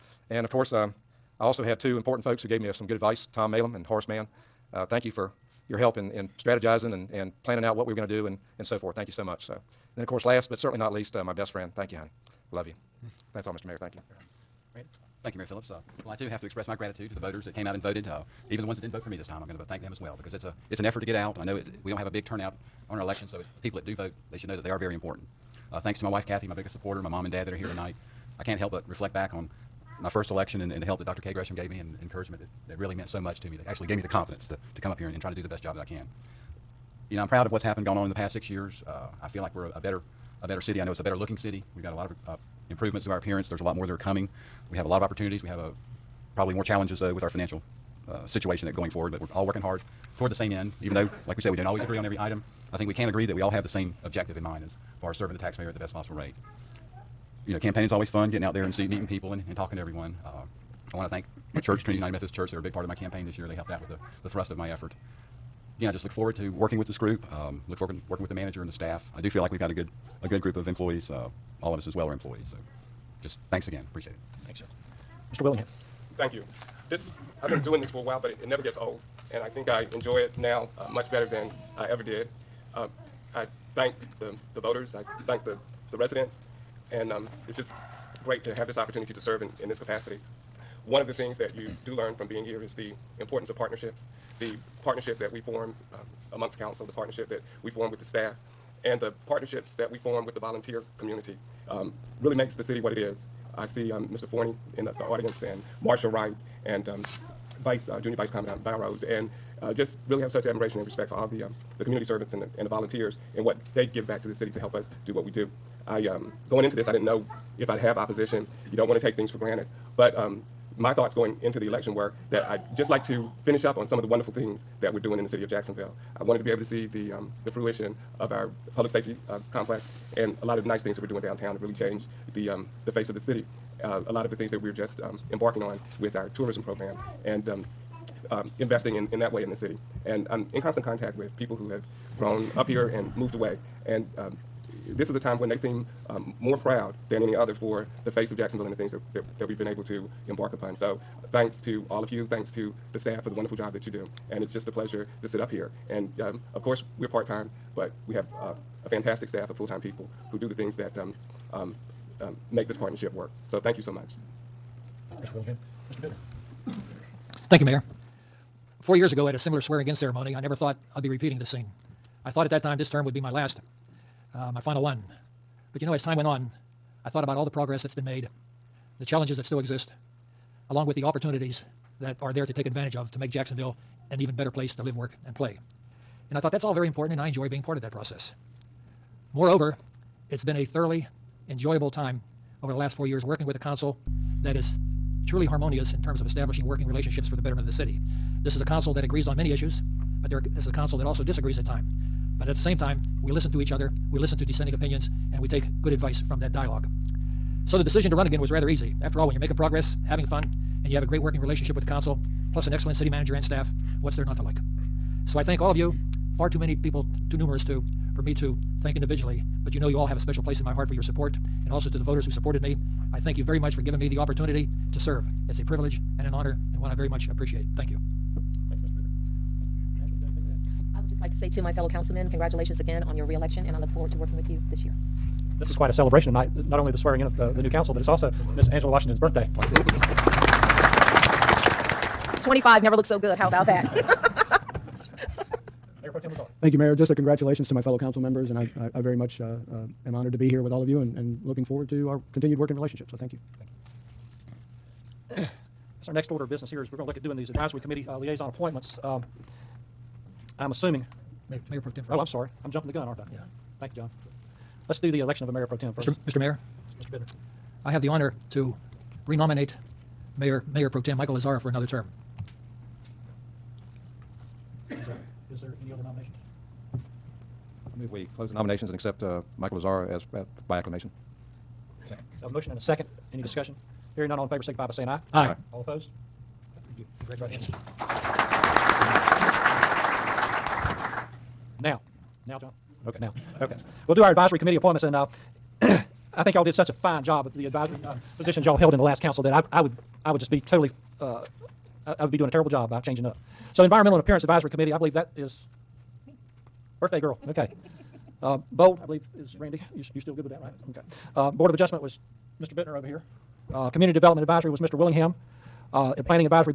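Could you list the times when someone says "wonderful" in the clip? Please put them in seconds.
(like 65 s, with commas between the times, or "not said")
124 s, 153 s.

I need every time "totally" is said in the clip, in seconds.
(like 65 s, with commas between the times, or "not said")
300 s.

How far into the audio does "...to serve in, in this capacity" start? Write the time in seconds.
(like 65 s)
89 s.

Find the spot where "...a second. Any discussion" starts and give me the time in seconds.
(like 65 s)
282 s.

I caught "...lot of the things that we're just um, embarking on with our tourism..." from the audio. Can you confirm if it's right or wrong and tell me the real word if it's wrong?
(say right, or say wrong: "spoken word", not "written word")
right.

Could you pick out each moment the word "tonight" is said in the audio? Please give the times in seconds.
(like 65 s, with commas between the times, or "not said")
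27 s, 236 s.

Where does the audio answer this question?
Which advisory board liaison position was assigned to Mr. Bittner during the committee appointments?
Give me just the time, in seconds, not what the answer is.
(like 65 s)
311 s.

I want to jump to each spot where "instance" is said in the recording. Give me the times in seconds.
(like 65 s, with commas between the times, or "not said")
not said.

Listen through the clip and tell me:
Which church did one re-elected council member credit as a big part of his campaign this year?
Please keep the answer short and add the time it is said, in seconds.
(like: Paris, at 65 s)
Trinity United Methodist Church, at 61 s.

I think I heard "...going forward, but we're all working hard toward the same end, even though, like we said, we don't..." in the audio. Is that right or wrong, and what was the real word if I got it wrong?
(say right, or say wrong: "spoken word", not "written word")
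right.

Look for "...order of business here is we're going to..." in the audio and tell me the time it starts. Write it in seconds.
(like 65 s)
256 s.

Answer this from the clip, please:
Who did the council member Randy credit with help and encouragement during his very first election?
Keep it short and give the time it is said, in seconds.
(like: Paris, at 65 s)
Dr. K. Gresham, at 31 s.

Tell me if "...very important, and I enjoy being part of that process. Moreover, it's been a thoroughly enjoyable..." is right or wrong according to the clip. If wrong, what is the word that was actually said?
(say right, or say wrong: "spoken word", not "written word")
right.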